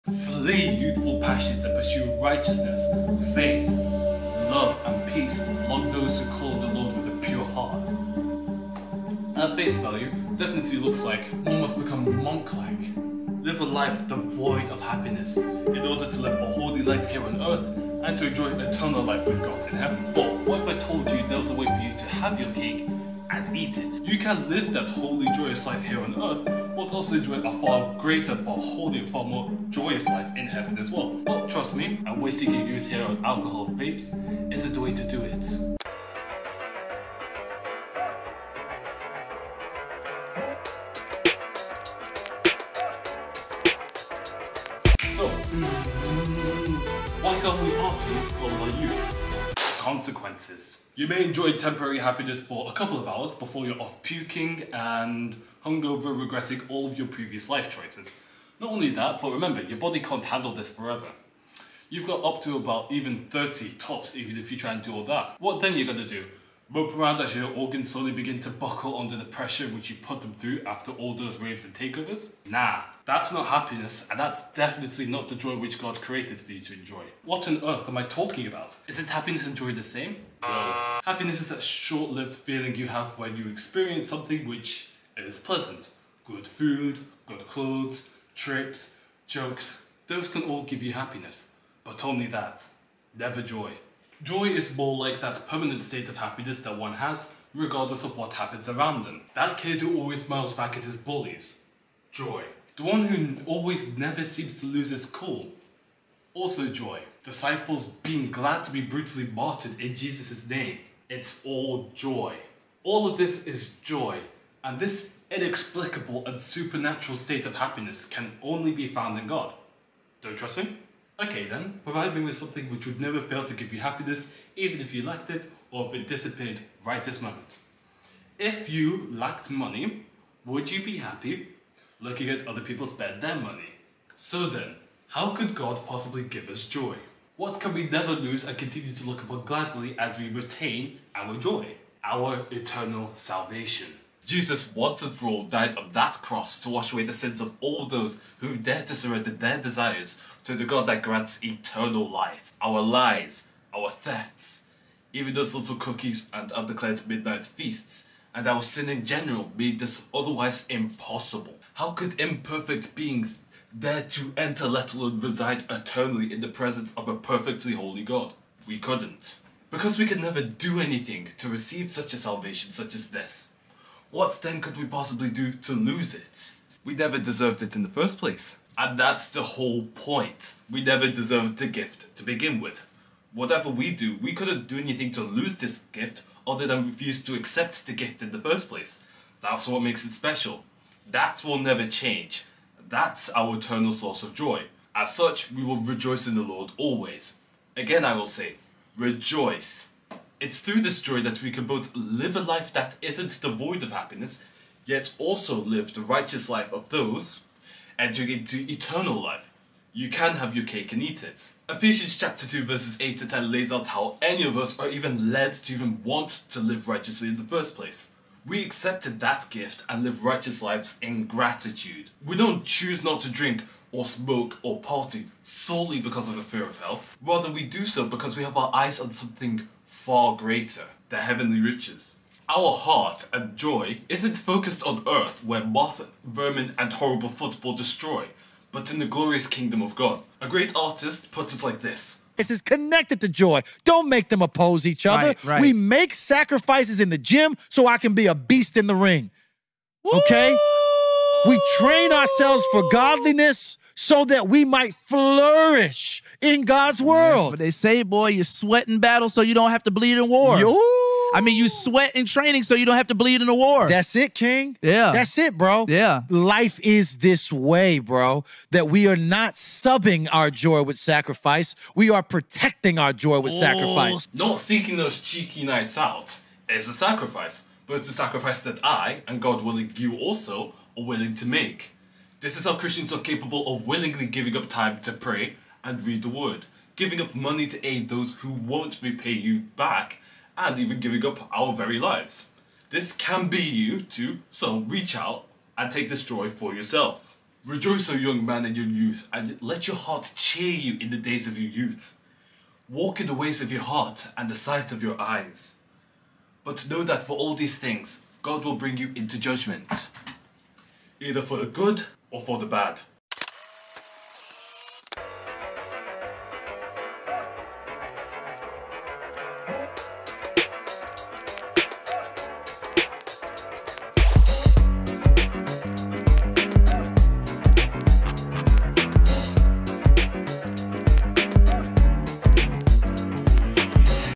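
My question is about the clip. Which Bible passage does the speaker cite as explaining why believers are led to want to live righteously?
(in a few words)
Ephesians 2:8-10.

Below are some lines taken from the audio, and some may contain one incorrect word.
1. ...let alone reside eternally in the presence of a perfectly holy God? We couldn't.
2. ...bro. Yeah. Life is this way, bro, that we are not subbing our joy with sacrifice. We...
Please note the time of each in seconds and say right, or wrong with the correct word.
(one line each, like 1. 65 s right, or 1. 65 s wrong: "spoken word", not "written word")
1. 164 s right
2. 265 s right.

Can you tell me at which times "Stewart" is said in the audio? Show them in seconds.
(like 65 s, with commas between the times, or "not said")
not said.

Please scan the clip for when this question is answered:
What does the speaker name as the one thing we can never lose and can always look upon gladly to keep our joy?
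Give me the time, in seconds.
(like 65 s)
142 s.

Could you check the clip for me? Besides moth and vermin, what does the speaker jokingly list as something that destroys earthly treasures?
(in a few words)
horrible football.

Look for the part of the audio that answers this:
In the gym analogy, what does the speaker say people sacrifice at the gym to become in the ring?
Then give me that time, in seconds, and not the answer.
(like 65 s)
248 s.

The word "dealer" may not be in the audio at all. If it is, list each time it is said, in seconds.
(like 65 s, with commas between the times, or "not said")
not said.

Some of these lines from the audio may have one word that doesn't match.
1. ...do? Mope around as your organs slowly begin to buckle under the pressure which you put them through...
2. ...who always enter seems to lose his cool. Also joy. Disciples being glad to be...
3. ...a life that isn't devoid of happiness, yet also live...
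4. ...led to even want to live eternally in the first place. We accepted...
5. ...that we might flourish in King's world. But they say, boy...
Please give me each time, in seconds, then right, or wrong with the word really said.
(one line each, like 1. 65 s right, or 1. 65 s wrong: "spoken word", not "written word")
1. 66 s right
2. 103 s wrong: "never", not "enter"
3. 202 s right
4. 215 s wrong: "righteously", not "eternally"
5. 254 s wrong: "God", not "King".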